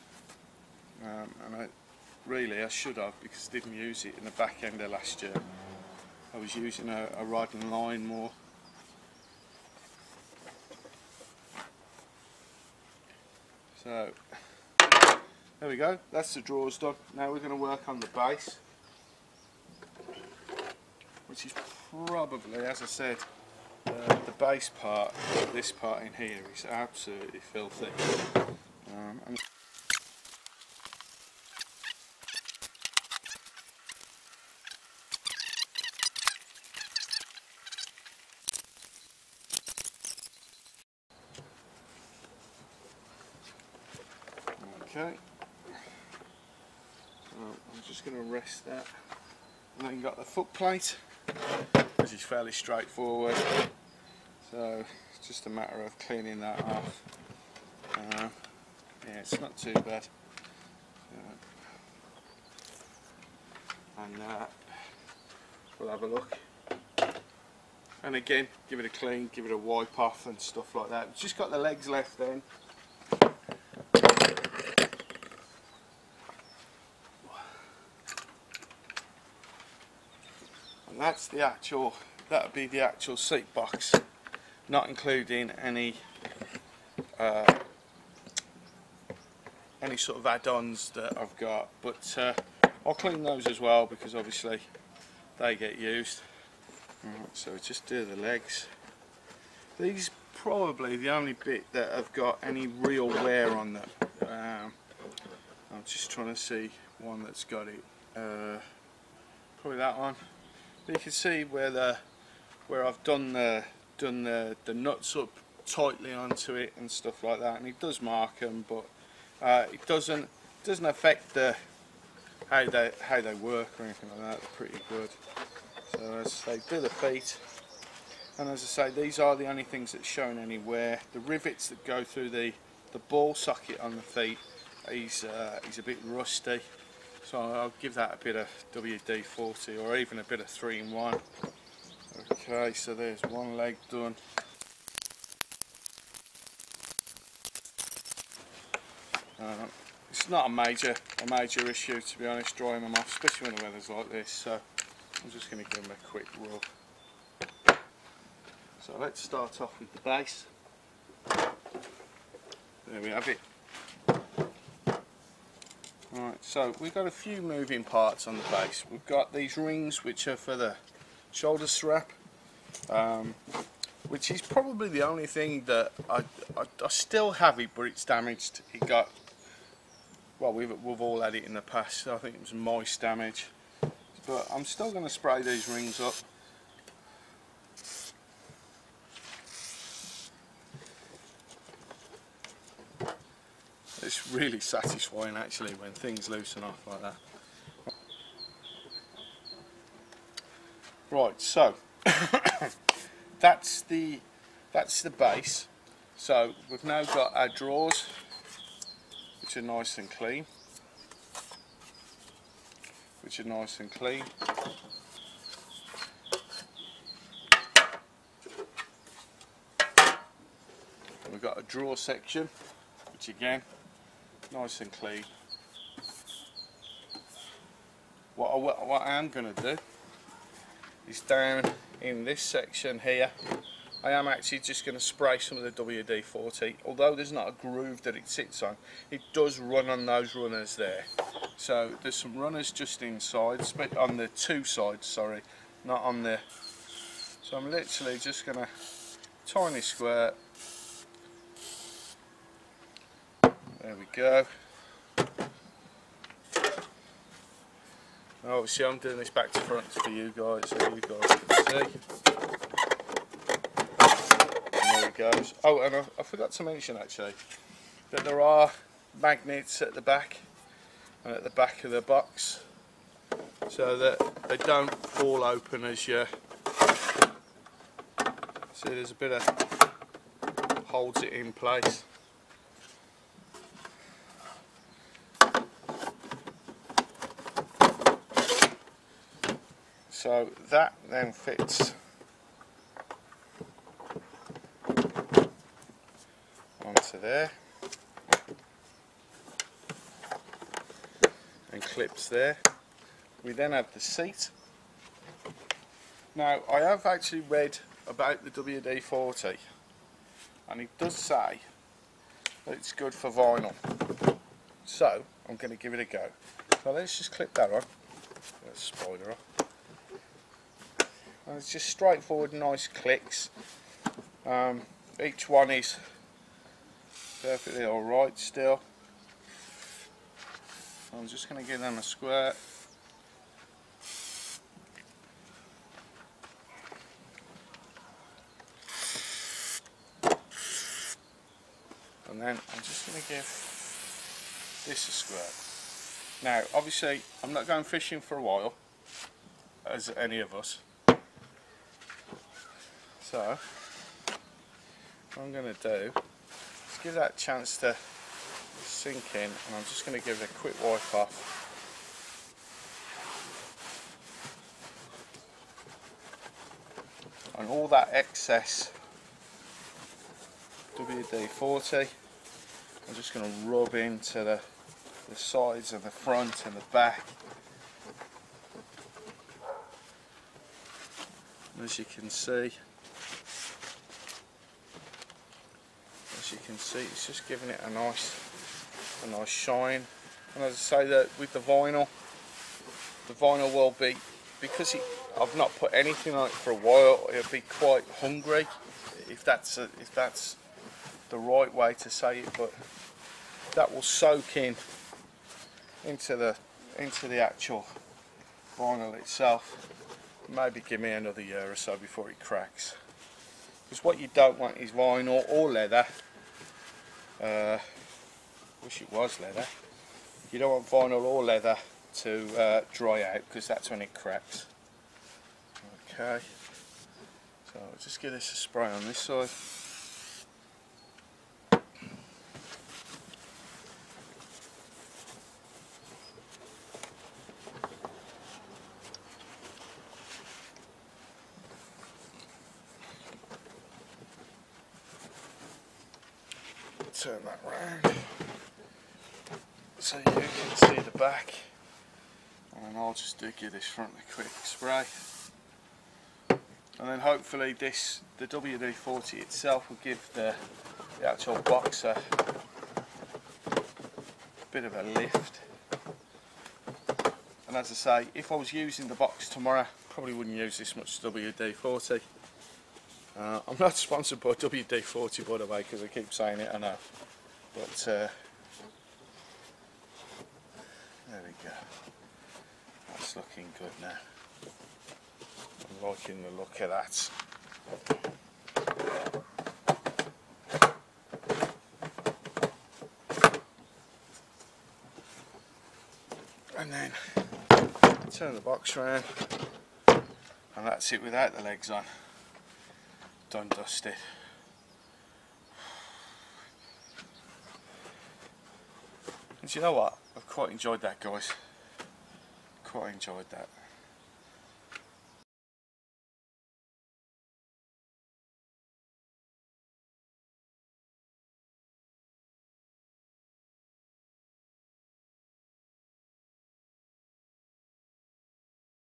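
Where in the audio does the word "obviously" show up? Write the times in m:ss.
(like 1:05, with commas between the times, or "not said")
1:34, 4:18, 5:46.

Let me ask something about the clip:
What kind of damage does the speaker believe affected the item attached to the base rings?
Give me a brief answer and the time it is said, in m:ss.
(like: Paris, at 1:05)
moist damage, at 3:02.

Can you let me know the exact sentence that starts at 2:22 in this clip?
Okay, so there's one leg done.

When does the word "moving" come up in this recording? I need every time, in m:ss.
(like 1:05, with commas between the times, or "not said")
2:47.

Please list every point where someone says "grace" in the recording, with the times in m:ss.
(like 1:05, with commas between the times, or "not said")
not said.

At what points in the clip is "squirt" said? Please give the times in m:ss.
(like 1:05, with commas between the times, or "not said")
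4:09, 5:45.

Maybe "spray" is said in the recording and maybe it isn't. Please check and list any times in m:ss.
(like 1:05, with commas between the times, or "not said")
3:05, 3:55, 7:08, 7:34.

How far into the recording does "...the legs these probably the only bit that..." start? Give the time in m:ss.
1:38.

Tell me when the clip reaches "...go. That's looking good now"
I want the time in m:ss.
8:01.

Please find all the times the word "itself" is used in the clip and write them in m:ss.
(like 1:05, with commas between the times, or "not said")
6:49, 7:39.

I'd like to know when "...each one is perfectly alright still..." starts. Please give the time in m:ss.
5:25.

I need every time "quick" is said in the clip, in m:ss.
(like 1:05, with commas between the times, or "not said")
2:36, 6:00, 7:34.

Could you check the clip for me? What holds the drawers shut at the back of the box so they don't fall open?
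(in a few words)
magnets.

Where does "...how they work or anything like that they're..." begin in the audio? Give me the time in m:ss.
2:02.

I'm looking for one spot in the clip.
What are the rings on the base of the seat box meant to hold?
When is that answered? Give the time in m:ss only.
2:51.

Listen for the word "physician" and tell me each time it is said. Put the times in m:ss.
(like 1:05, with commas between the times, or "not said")
not said.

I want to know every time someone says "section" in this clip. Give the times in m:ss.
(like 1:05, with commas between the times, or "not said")
3:41, 3:52.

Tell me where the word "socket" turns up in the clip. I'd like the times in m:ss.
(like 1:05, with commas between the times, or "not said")
2:13.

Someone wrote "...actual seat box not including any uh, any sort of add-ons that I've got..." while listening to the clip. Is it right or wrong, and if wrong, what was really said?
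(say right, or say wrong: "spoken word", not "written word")
right.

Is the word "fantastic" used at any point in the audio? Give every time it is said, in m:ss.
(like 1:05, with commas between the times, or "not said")
not said.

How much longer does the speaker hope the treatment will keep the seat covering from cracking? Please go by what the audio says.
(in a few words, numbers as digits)
another year.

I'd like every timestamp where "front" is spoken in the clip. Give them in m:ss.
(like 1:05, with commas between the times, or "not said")
4:19, 6:16, 7:33.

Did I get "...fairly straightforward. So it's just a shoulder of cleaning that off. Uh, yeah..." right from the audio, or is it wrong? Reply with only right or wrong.
wrong.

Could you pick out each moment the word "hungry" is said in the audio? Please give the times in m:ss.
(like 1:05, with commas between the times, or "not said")
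6:38.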